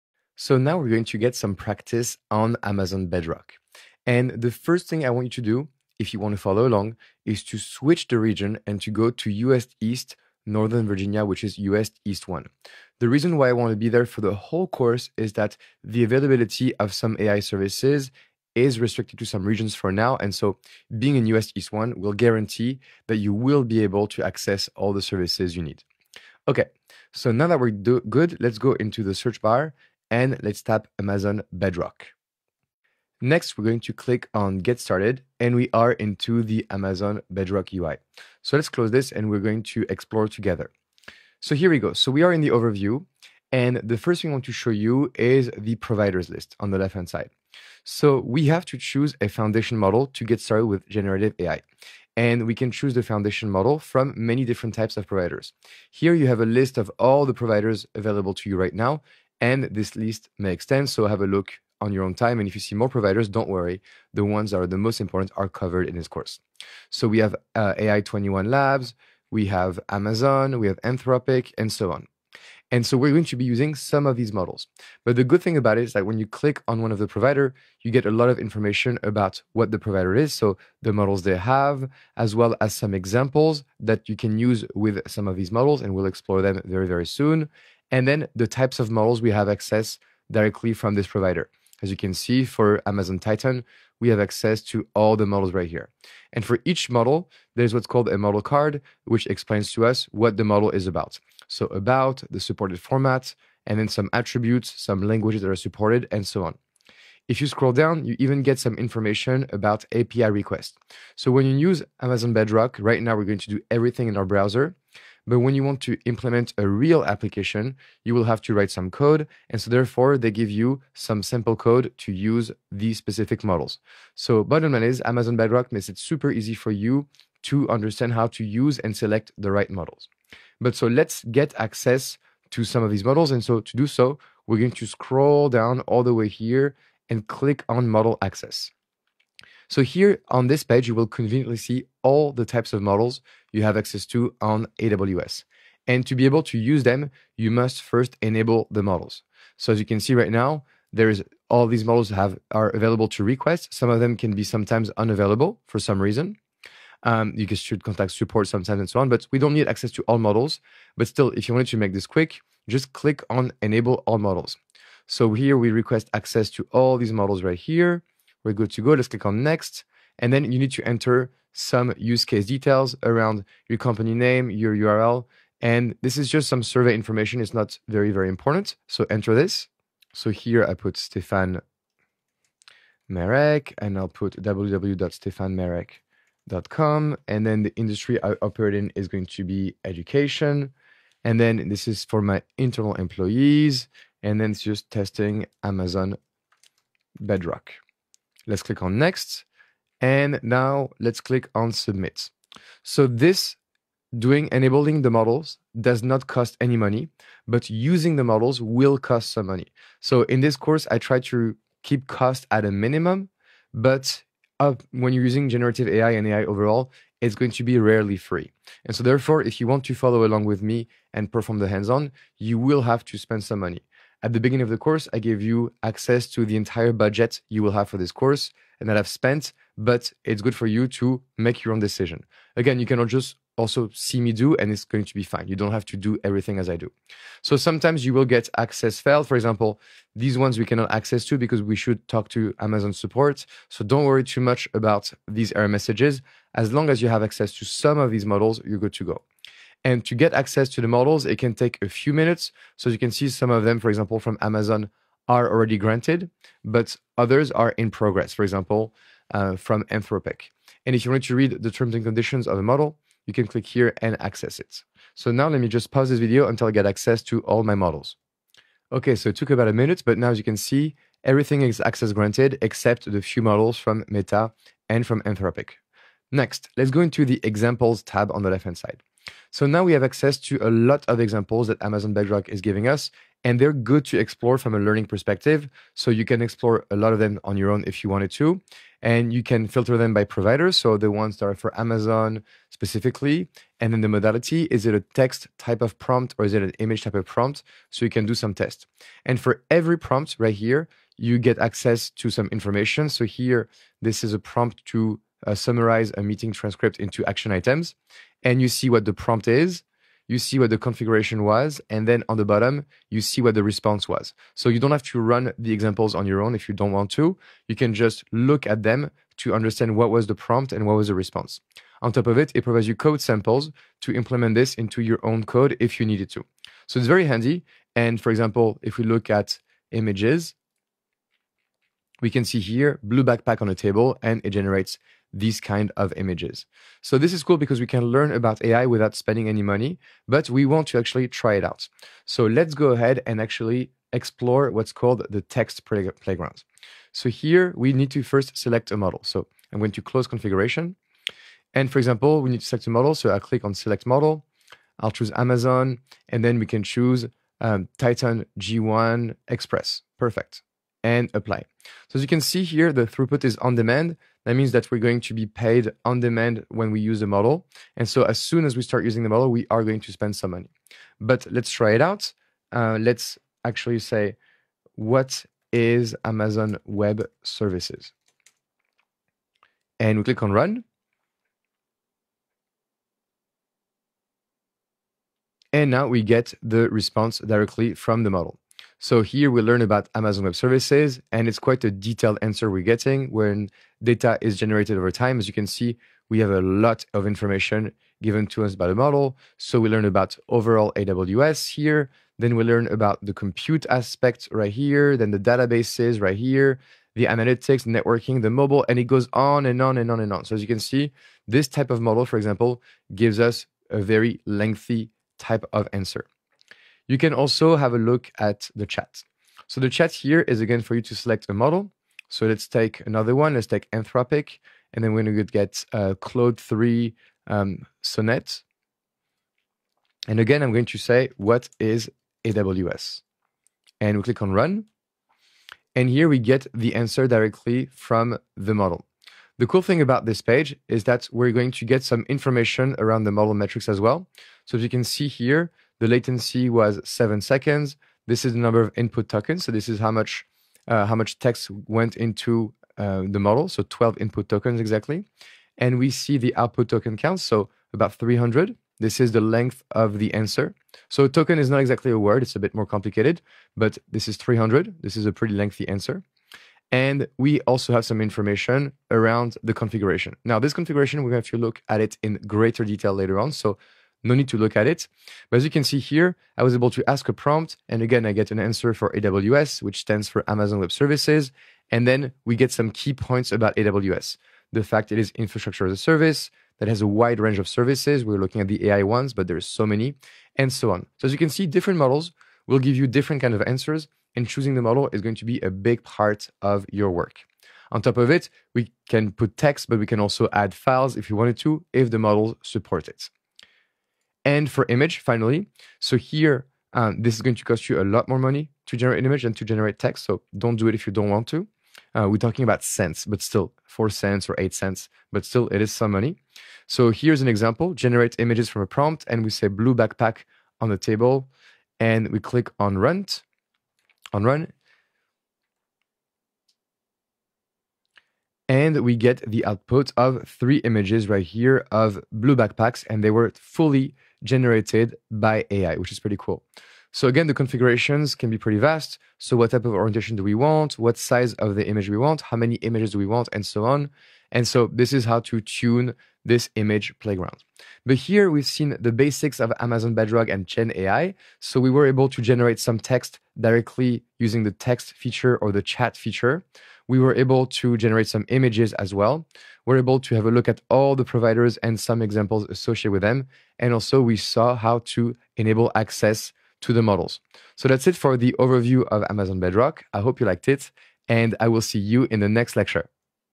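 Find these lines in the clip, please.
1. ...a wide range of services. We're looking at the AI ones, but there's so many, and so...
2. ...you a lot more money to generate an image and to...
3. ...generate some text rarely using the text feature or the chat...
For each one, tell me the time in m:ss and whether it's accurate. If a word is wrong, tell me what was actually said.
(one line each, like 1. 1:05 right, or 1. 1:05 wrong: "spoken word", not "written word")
1. 8:07 right
2. 8:27 right
3. 9:12 wrong: "directly", not "rarely".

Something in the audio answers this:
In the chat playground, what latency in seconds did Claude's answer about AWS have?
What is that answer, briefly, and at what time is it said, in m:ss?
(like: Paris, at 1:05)
7 seconds, at 7:27.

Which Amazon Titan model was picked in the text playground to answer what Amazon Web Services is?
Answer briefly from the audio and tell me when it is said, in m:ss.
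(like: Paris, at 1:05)
Titan G1 Express, at 5:57.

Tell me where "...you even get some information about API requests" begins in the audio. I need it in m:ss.
1:48.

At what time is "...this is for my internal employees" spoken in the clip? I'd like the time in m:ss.
3:11.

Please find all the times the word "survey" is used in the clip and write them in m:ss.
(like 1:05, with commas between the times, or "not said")
2:56.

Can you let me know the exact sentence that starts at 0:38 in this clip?
So let's close this, and we're going to explore together.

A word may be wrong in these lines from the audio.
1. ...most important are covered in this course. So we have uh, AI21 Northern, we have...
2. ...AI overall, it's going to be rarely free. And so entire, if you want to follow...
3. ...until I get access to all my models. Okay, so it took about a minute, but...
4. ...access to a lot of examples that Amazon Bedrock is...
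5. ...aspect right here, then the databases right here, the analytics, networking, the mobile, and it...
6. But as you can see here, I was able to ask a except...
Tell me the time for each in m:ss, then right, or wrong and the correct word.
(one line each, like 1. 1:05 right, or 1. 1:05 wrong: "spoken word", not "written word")
1. 1:04 wrong: "Labs", not "Northern"
2. 3:36 wrong: "therefore", not "entire"
3. 4:26 right
4. 4:40 right
5. 6:43 right
6. 7:55 wrong: "prompt", not "except".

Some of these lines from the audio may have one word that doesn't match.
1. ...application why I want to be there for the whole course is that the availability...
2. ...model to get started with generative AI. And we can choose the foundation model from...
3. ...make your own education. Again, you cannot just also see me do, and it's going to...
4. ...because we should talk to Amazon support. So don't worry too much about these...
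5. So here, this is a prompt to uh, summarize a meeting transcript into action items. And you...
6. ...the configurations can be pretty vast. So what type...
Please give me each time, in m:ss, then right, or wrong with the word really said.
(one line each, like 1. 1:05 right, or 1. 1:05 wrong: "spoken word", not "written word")
1. 0:13 wrong: "reason", not "application"
2. 0:49 right
3. 3:51 wrong: "decision", not "education"
4. 4:01 right
5. 5:03 right
6. 8:57 right.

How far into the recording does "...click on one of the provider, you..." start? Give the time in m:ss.
1:16.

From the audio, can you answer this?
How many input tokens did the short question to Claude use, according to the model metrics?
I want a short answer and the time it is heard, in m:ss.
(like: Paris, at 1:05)
12, at 7:33.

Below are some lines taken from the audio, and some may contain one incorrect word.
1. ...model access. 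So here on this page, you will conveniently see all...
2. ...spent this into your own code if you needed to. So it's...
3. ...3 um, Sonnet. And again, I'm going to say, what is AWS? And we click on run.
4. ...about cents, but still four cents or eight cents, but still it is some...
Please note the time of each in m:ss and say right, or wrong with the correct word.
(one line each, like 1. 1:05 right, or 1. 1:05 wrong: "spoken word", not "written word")
1. 2:17 right
2. 5:24 wrong: "implement", not "spent"
3. 7:06 right
4. 8:32 right.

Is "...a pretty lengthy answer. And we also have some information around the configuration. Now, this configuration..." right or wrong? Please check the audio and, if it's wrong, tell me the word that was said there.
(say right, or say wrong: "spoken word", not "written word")
right.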